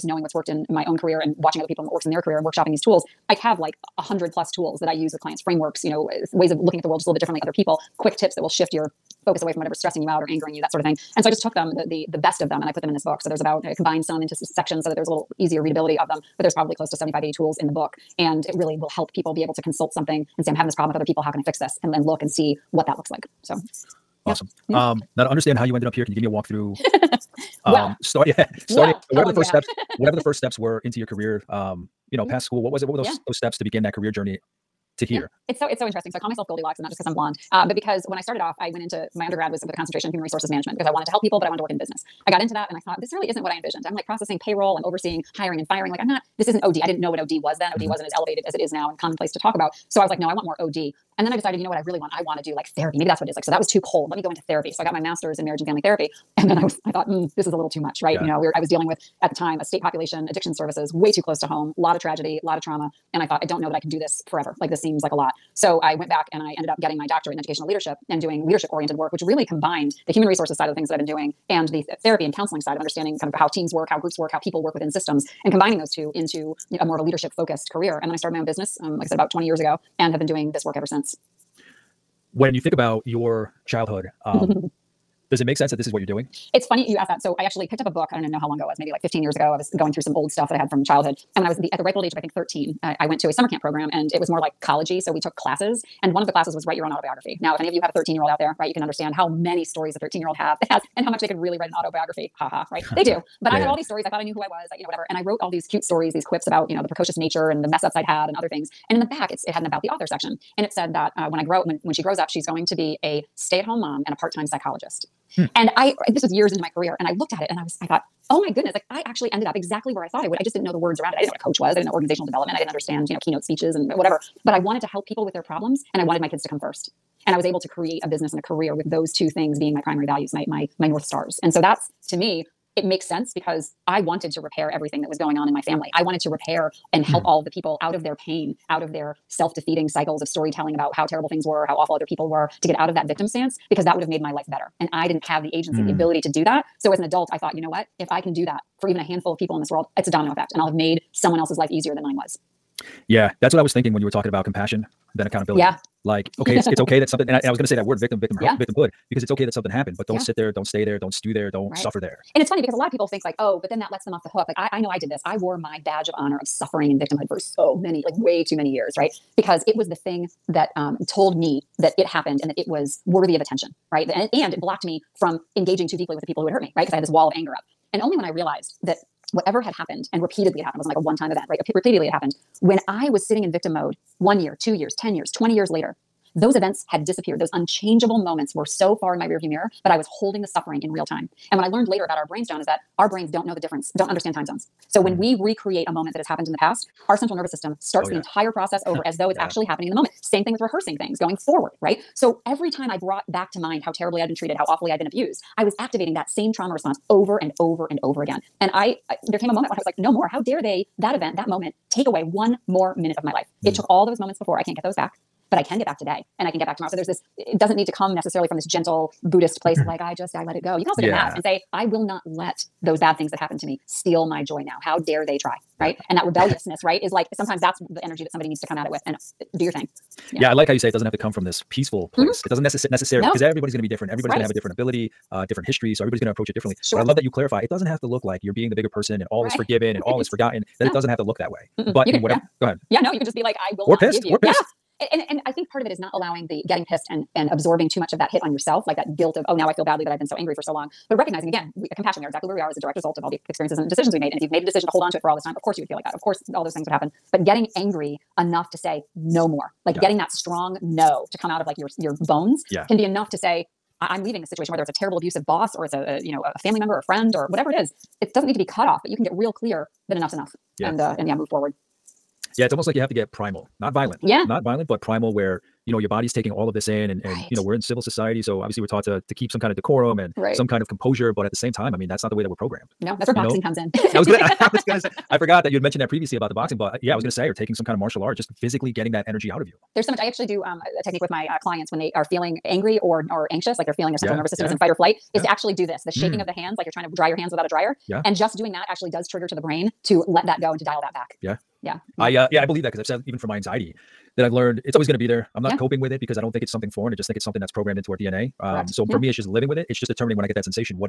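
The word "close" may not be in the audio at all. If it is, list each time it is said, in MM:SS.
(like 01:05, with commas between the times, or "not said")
00:16, 01:01.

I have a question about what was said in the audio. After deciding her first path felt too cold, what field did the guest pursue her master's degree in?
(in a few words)
Marriage and family therapy.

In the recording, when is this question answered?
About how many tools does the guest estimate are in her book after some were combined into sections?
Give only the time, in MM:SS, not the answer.
00:16.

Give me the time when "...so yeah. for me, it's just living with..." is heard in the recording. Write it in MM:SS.
05:08.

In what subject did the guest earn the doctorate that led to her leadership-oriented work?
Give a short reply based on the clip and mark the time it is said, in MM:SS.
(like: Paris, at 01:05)
Educational leadership, at 01:07.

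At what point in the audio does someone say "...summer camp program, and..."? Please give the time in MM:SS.
01:33.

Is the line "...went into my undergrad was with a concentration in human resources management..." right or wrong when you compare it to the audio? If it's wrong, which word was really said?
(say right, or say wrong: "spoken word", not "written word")
right.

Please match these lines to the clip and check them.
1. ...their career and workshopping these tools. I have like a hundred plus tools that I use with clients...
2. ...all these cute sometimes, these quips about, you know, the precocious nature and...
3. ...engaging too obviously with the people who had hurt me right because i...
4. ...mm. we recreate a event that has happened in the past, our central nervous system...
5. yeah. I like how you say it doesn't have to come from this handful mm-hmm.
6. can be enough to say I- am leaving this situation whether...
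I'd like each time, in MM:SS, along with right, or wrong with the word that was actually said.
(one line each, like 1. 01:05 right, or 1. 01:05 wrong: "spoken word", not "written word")
1. 00:02 right
2. 01:45 wrong: "stories", not "sometimes"
3. 02:55 wrong: "deeply", not "obviously"
4. 03:15 wrong: "moment", not "event"
5. 03:50 wrong: "peaceful", not "handful"
6. 04:22 right.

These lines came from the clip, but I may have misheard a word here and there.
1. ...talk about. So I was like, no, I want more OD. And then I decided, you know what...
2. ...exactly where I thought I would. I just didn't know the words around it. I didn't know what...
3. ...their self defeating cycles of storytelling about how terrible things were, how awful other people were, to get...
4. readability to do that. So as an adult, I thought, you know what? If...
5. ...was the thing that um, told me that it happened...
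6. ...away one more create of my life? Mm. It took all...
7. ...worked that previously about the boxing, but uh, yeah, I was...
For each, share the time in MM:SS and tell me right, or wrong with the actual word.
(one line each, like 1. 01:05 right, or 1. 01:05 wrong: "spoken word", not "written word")
1. 00:49 right
2. 01:59 right
3. 02:18 right
4. 02:25 wrong: "ability", not "readability"
5. 02:49 right
6. 03:32 wrong: "minute", not "create"
7. 04:45 wrong: "mentioned", not "worked".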